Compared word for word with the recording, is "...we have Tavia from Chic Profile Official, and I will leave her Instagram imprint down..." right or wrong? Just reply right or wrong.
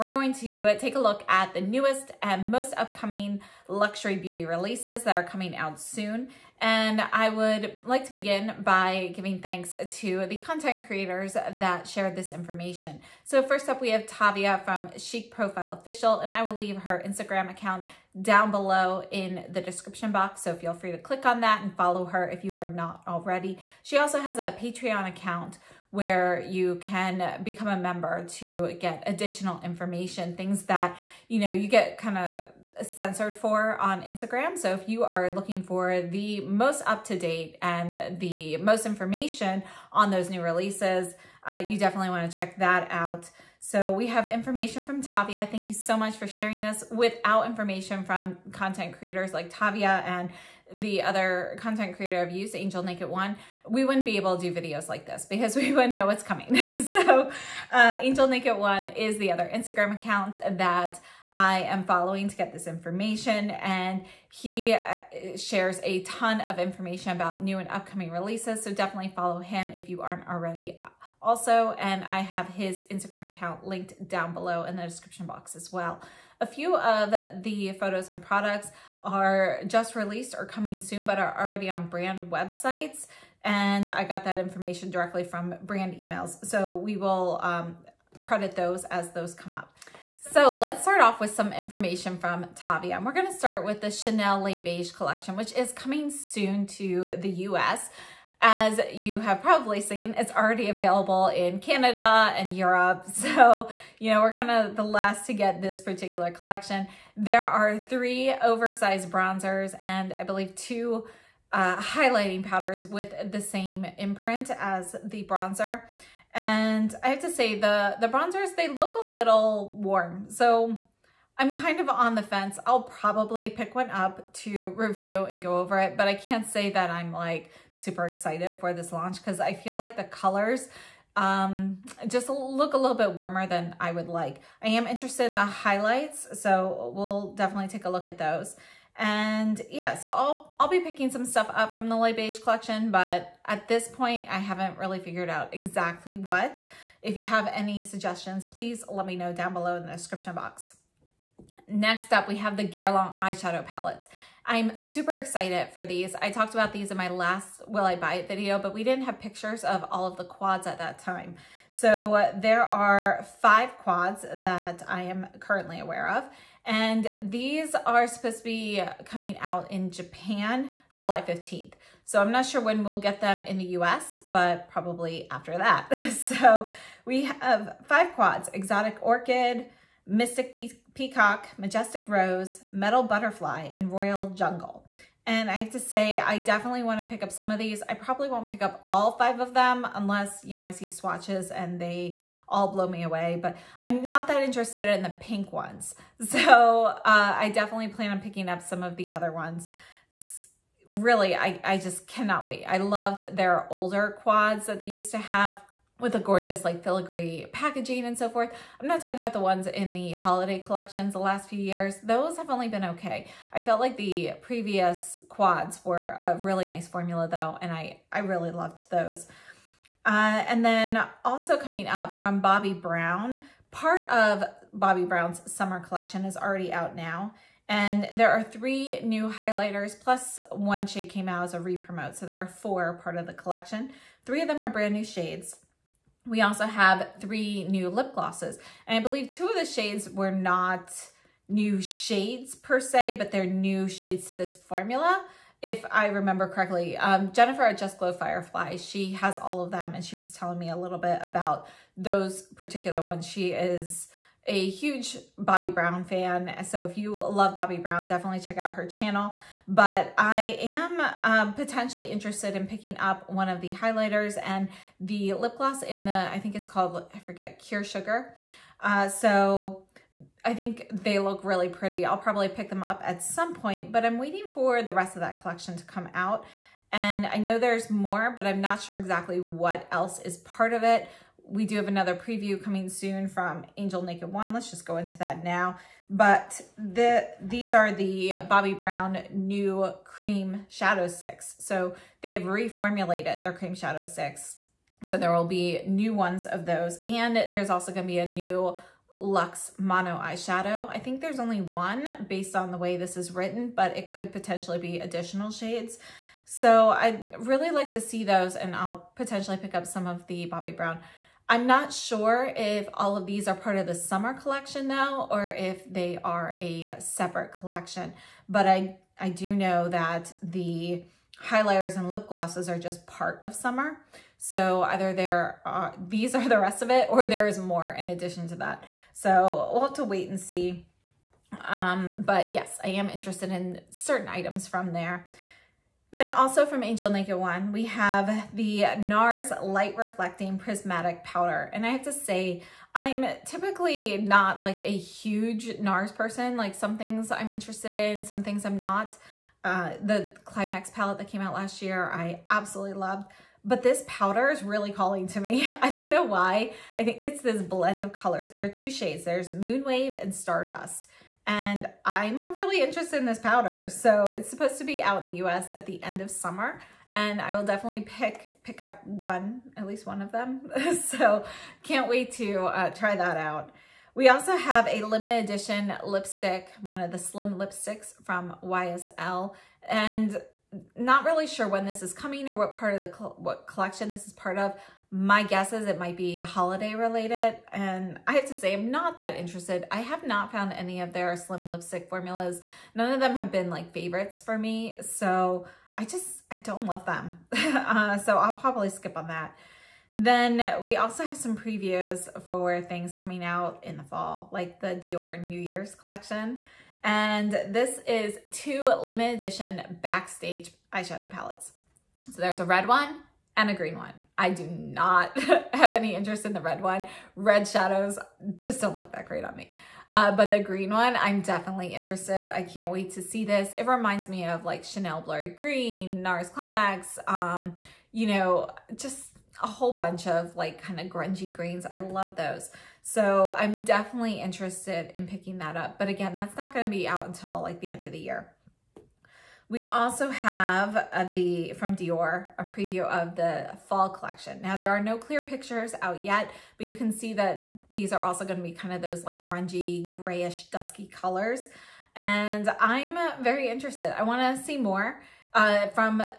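wrong.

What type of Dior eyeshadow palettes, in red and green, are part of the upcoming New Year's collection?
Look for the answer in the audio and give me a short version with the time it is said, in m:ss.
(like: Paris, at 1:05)
Backstage, at 6:50.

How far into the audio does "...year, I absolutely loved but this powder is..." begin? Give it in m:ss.
5:51.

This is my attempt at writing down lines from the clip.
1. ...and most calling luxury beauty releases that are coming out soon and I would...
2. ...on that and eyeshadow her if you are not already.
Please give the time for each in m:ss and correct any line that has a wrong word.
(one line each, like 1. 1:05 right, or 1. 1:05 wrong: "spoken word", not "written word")
1. 0:02 wrong: "upcoming", not "calling"
2. 0:21 wrong: "follow", not "eyeshadow".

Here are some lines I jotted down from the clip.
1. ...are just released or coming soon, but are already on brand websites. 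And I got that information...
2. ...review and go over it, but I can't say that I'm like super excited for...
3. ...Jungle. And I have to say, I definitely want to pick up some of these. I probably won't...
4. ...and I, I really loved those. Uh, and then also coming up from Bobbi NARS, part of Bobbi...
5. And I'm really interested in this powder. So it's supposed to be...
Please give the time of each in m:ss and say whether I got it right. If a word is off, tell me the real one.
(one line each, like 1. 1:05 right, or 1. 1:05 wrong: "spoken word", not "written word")
1. 1:19 right
2. 2:04 right
3. 3:04 right
4. 3:37 wrong: "Brown", not "NARS"
5. 6:01 right.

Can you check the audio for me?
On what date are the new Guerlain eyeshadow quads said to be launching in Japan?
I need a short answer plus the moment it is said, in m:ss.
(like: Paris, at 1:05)
July 15th, at 2:50.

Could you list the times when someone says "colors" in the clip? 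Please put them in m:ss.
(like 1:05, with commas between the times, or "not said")
2:10, 5:58, 7:31.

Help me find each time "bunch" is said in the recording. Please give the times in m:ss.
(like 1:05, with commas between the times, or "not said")
7:09.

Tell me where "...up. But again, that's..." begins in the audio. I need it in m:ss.
7:15.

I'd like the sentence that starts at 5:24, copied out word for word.
So either there, are these are the rest of it or there is more in addition to that.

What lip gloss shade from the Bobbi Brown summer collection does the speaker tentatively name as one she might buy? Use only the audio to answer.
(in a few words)
Cure Sugar.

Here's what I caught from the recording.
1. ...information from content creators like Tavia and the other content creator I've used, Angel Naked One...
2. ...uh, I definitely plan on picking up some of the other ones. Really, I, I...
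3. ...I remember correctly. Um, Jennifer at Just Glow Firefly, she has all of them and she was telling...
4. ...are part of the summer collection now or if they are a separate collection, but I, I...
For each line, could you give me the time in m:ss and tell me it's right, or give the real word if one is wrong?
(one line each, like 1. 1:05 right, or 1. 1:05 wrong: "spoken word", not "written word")
1. 0:47 right
2. 3:16 right
3. 4:05 right
4. 5:13 right.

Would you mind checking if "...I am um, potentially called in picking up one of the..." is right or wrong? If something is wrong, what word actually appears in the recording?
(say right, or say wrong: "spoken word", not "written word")
wrong: "interested", not "called".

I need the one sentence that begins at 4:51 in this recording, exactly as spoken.
So they have reformulated their cream shadow sticks.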